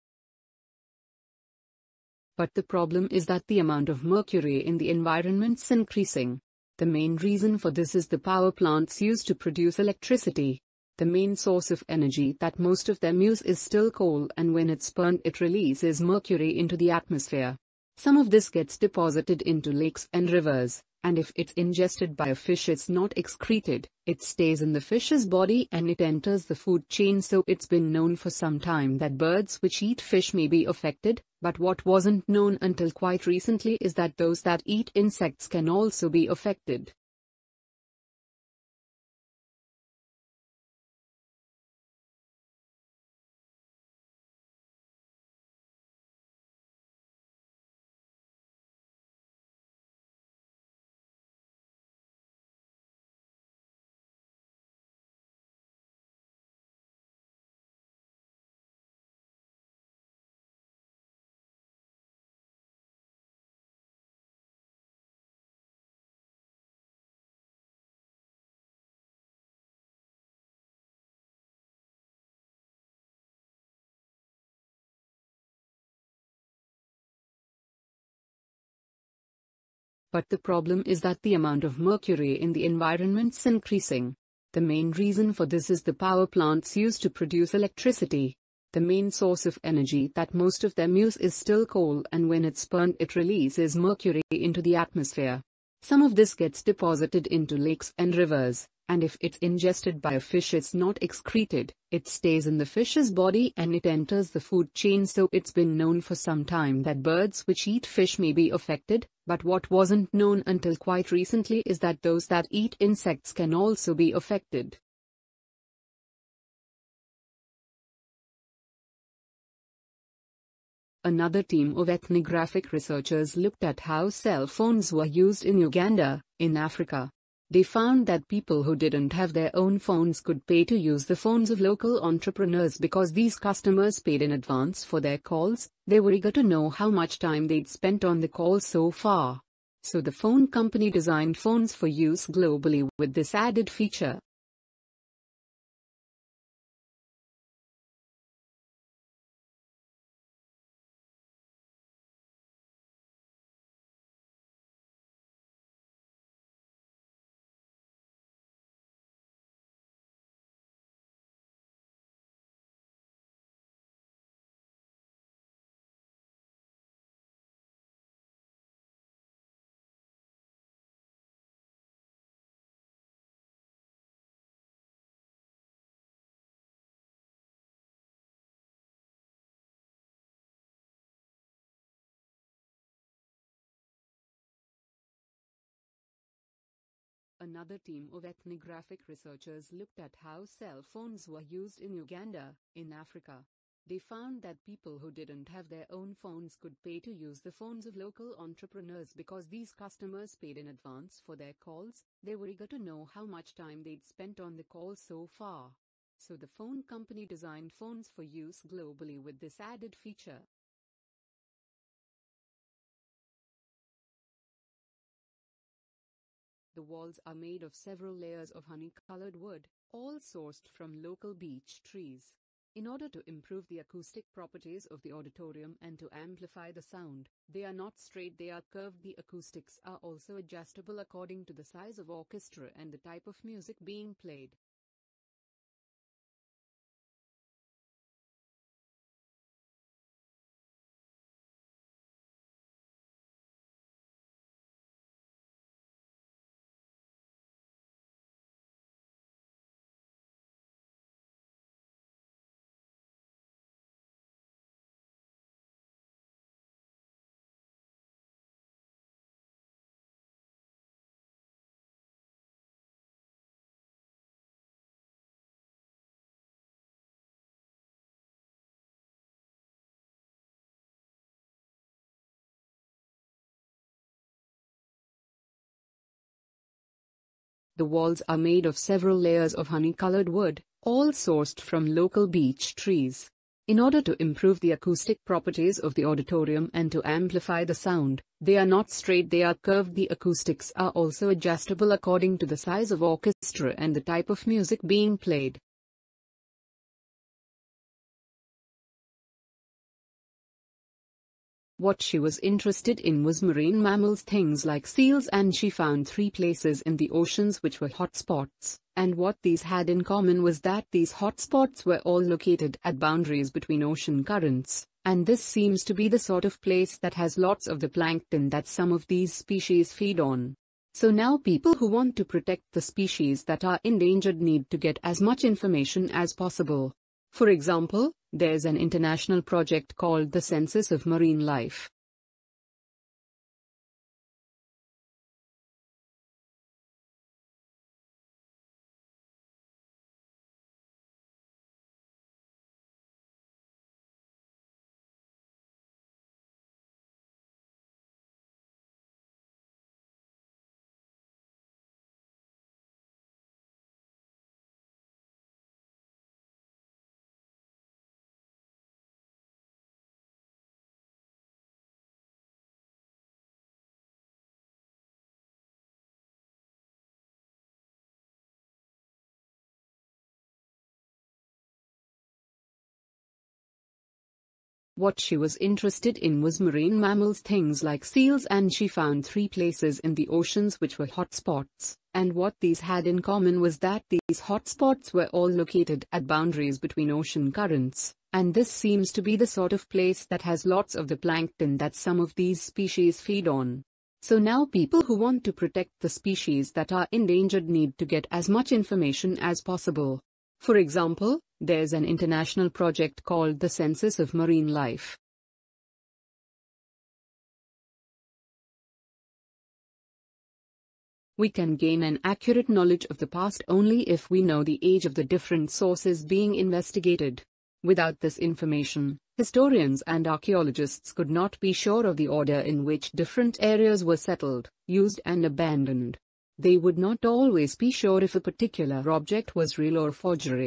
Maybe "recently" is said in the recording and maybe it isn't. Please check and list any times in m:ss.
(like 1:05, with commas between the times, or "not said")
0:33, 1:51.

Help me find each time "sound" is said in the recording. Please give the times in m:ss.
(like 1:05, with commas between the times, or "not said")
3:46, 4:47.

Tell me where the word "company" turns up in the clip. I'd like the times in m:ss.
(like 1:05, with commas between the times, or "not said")
2:20, 3:26.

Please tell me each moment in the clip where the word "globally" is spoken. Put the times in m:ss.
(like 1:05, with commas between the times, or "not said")
2:22, 3:28.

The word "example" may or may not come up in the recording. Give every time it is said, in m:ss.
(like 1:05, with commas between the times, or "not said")
5:27, 6:40.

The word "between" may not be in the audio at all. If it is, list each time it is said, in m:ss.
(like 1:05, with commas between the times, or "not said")
5:13, 6:26.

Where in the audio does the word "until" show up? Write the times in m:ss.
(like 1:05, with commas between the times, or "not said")
0:32, 1:50.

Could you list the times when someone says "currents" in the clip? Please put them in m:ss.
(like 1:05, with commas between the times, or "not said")
5:14, 6:27.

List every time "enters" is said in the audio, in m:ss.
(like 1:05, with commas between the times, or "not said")
0:26, 1:43.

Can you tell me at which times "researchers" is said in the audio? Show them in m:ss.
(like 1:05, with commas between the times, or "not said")
2:02, 3:09.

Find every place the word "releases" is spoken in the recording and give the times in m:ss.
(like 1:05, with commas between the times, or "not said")
0:15, 1:33.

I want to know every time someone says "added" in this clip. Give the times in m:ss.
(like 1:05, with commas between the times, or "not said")
2:23, 3:29.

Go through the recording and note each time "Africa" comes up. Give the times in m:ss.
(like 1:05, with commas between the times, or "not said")
2:06, 3:12.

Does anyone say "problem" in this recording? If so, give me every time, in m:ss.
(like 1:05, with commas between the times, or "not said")
0:02, 1:20.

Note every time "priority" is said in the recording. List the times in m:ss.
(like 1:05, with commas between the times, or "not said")
not said.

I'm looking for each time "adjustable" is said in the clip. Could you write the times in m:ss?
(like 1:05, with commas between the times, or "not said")
3:50, 4:51.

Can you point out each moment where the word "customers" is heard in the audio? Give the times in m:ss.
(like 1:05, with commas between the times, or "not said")
2:13, 3:19.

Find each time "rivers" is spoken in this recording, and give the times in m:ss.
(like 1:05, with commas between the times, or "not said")
0:20, 1:38.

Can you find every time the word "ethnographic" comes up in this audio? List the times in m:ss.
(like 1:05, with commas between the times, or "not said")
2:01, 3:08.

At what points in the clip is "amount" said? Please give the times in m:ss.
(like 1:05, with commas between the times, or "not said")
0:03, 1:21.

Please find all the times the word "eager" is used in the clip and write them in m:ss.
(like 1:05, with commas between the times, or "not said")
2:16, 3:22.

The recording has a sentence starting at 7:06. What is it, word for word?
They would not always be sure if a particular object was real or forgery.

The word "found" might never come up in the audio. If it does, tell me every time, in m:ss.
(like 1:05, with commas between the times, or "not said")
2:07, 3:13, 5:05, 6:18.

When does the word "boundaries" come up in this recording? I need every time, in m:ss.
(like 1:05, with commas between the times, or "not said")
5:12, 6:26.